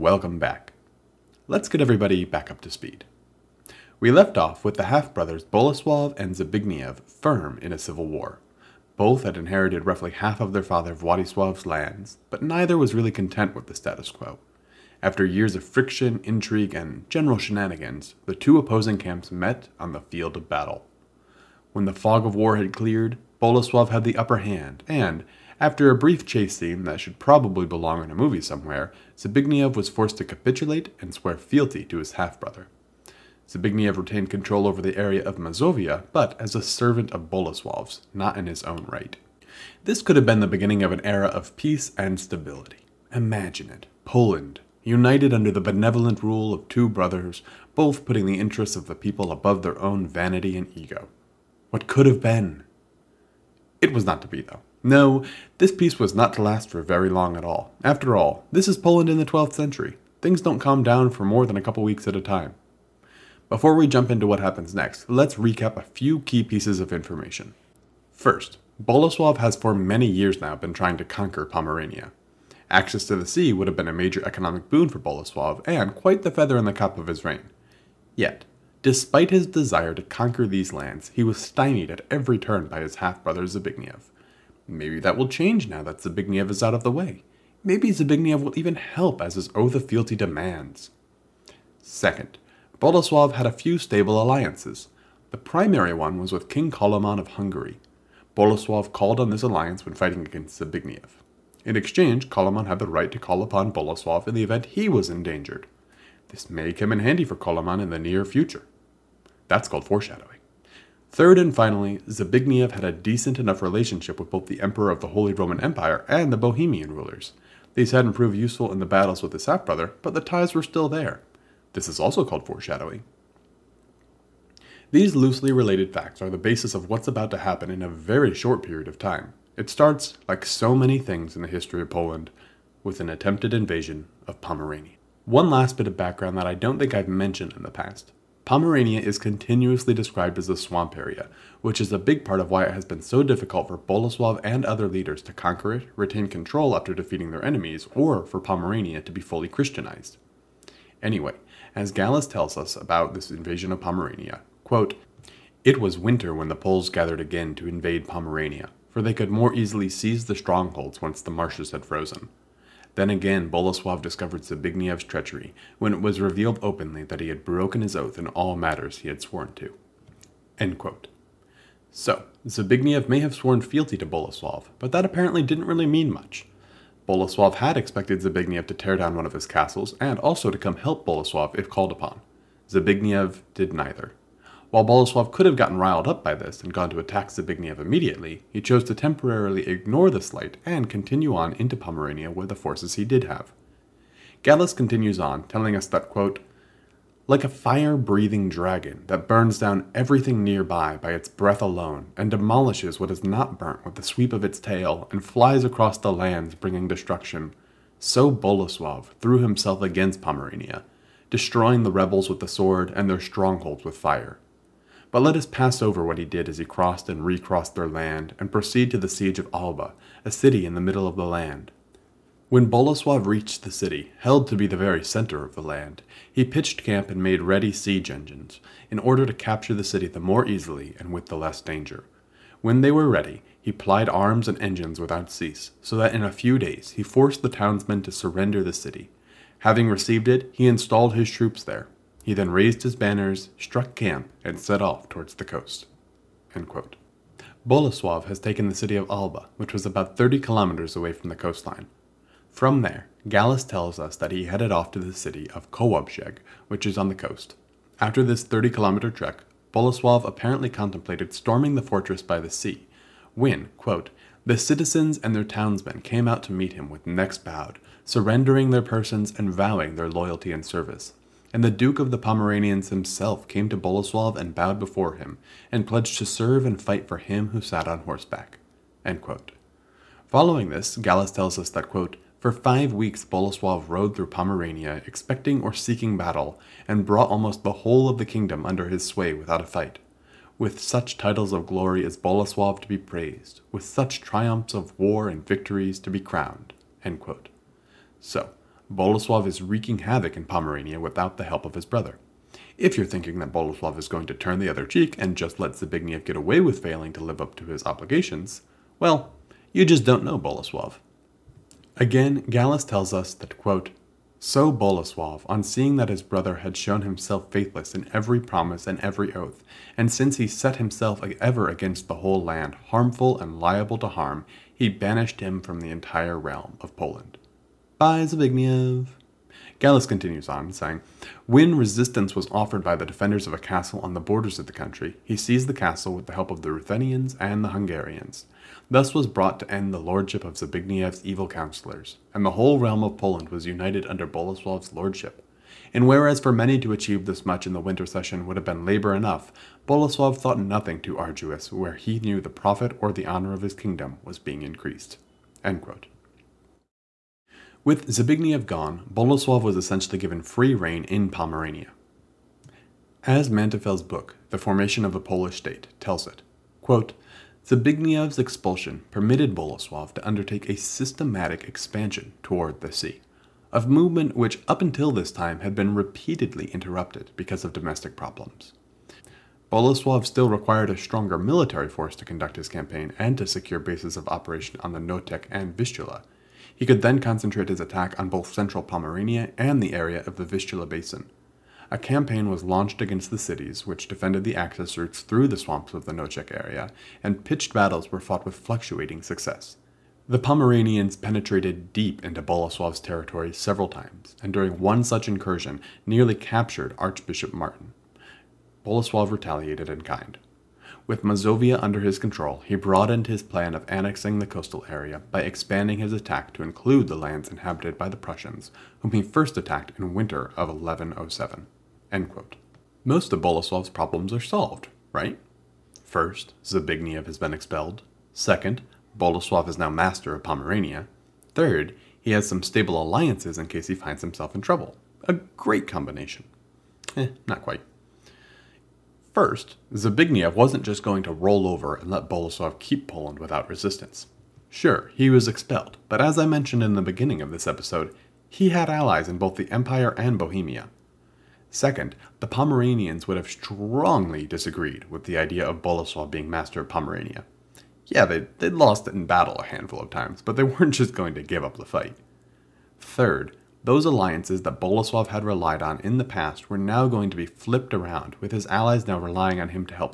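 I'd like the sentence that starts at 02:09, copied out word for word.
It starts, like so many things in the history of Poland, with an attempted invasion of Pomerania.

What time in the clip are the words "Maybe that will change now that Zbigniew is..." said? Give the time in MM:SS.
01:24.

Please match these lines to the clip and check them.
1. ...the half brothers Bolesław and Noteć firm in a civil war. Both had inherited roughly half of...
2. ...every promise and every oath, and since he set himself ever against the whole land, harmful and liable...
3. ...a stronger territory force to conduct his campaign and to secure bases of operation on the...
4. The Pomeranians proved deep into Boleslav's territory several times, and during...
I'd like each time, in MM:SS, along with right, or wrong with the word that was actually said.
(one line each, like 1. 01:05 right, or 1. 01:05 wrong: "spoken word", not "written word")
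1. 00:04 wrong: "Zbigniew", not "Noteć"
2. 05:18 right
3. 06:20 wrong: "military", not "territory"
4. 06:40 wrong: "penetrated", not "proved".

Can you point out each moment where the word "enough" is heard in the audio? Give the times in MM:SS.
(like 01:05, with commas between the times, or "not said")
01:53, 05:49.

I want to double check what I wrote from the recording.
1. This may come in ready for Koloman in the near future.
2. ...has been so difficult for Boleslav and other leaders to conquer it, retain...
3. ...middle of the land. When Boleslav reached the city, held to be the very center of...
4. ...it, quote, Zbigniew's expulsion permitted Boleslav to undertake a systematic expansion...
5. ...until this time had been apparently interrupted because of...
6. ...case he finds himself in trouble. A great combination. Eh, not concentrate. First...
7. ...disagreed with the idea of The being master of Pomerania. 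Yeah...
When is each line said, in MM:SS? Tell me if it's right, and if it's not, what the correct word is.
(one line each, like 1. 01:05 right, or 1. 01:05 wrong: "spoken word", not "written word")
1. 01:46 wrong: "handy", not "ready"
2. 02:22 right
3. 03:40 right
4. 06:06 right
5. 06:14 wrong: "repeatedly", not "apparently"
6. 07:13 wrong: "quite", not "concentrate"
7. 07:34 wrong: "Boleslav", not "The".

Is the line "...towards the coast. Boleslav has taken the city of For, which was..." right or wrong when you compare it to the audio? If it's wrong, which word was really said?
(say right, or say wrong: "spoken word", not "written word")
wrong: "Alba", not "For".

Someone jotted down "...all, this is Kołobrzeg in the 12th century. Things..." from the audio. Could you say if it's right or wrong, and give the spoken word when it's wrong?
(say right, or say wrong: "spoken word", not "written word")
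wrong: "Poland", not "Kołobrzeg".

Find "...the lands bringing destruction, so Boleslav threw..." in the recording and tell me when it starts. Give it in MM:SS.
03:25.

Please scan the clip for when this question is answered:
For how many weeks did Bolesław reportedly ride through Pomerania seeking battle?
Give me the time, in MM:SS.
04:42.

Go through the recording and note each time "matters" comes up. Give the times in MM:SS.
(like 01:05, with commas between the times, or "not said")
02:48.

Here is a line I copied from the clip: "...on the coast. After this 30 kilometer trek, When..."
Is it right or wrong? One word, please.
wrong.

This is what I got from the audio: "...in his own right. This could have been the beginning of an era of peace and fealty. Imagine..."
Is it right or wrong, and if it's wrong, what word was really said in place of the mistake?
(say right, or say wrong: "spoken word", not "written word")
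wrong: "stability", not "fealty".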